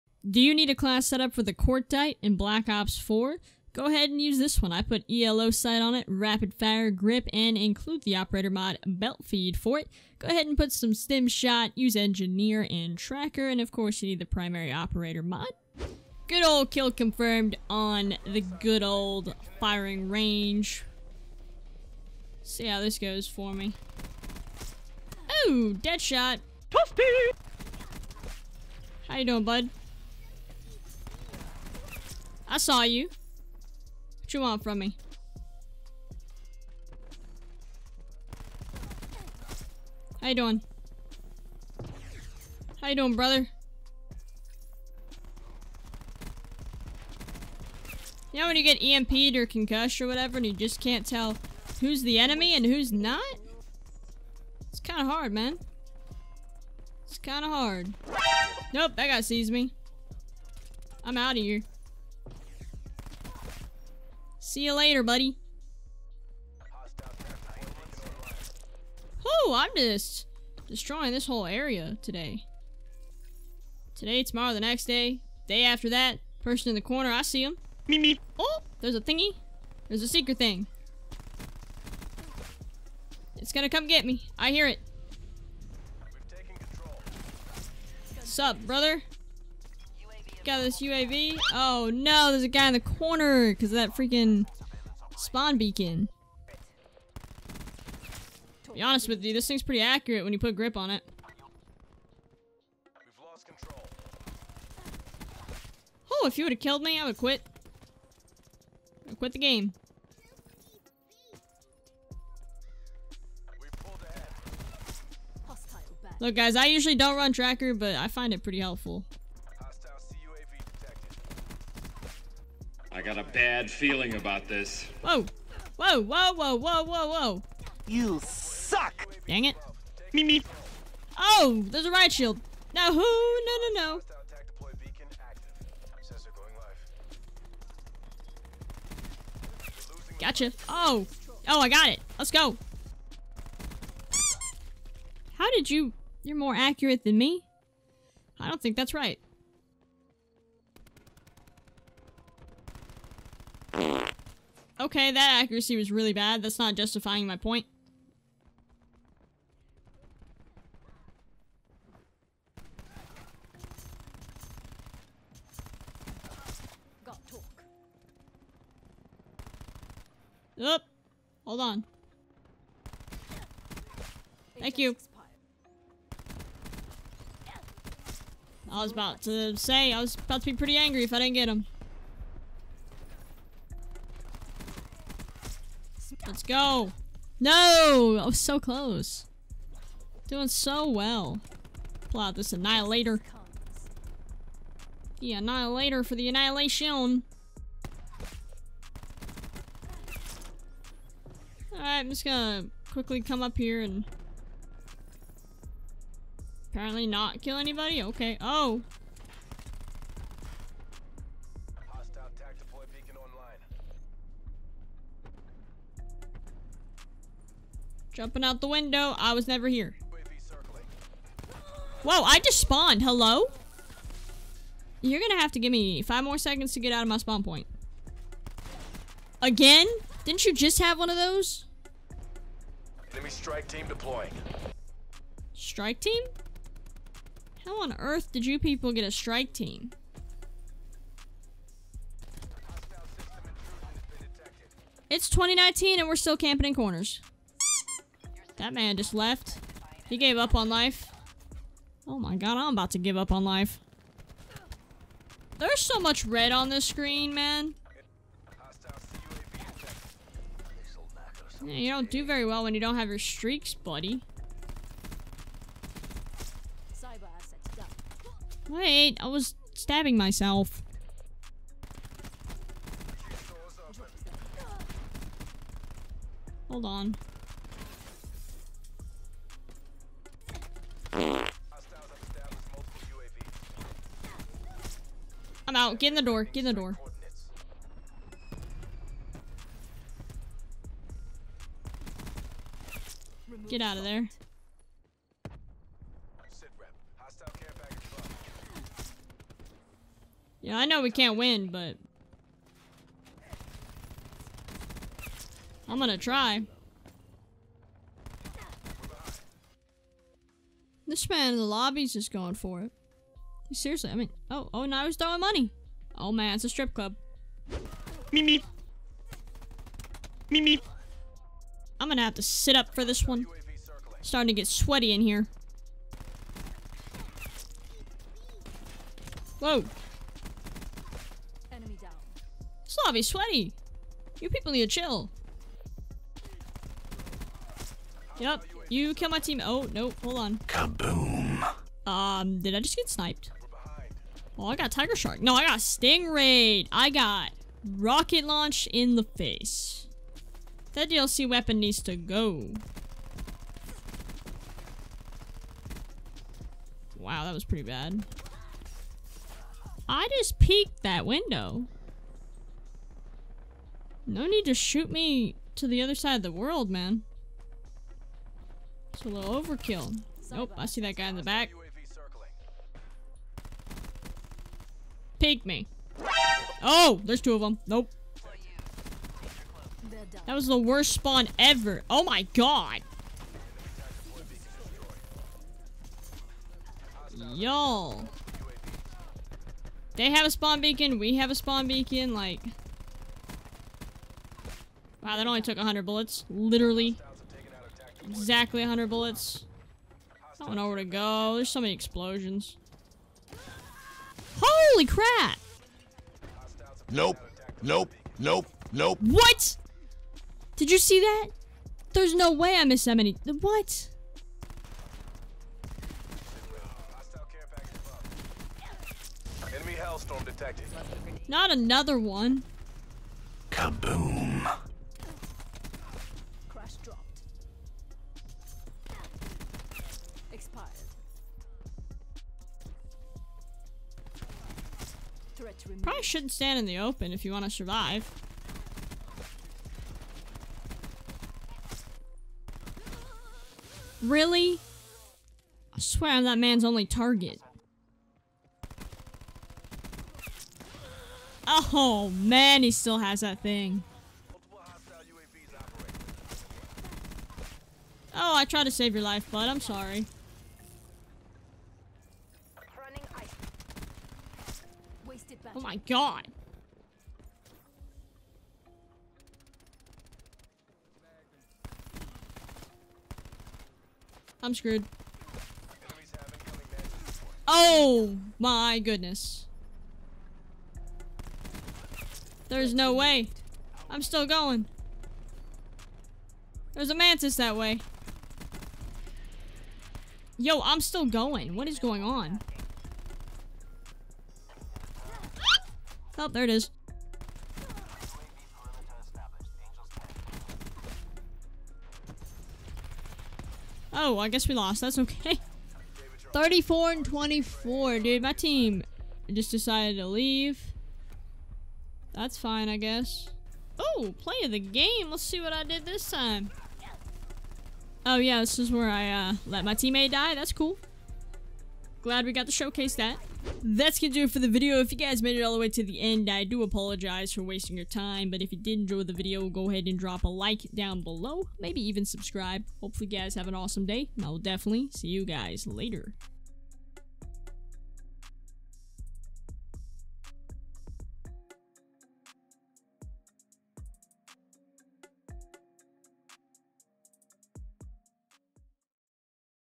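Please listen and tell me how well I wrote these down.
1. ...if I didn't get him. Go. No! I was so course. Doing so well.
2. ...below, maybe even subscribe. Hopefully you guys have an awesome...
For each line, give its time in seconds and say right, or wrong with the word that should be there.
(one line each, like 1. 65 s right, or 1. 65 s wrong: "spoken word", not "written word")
1. 181 s wrong: "close", not "course"
2. 531 s right.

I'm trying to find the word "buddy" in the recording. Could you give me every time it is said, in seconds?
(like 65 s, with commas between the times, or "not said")
65 s, 263 s.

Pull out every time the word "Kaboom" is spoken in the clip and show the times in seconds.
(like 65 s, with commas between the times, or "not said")
340 s, 423 s.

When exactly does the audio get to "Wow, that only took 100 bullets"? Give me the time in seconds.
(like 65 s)
395 s.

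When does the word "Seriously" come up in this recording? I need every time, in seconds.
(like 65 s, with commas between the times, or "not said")
313 s.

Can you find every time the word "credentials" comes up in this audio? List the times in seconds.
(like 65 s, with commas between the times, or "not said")
not said.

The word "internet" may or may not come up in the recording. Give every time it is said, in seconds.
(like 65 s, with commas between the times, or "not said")
not said.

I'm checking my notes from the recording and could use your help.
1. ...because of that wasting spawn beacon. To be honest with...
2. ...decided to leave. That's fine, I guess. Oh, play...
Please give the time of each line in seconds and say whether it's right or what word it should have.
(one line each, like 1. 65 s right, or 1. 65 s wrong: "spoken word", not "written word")
1. 93 s wrong: "freaking", not "wasting"
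2. 509 s right.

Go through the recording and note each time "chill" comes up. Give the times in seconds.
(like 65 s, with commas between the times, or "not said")
334 s.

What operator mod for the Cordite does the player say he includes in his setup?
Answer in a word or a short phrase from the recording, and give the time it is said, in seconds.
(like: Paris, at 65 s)
Belt feed, at 8 s.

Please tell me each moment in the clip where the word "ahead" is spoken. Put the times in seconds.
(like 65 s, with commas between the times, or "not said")
3 s, 10 s, 529 s.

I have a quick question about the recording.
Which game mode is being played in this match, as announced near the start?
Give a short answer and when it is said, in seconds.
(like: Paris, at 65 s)
Kill confirmed, at 16 s.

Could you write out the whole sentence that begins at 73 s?
Today, tomorrow, the next day, day after that, person in the corner, I see him.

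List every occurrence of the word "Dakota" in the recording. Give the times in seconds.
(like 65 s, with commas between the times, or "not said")
not said.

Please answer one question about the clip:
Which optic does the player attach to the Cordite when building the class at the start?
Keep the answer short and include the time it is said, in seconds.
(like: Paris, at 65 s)
ELO sight, at 5 s.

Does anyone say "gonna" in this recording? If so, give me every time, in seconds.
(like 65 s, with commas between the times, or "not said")
83 s, 202 s, 225 s, 305 s, 322 s, 524 s.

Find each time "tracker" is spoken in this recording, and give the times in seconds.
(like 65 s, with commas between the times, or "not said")
12 s, 117 s.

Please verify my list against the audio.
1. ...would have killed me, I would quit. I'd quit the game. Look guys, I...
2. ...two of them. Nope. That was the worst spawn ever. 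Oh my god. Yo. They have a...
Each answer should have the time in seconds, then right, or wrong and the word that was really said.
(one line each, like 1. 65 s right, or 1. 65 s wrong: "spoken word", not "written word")
1. 106 s right
2. 377 s right.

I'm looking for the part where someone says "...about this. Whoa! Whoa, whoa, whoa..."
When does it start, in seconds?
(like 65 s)
124 s.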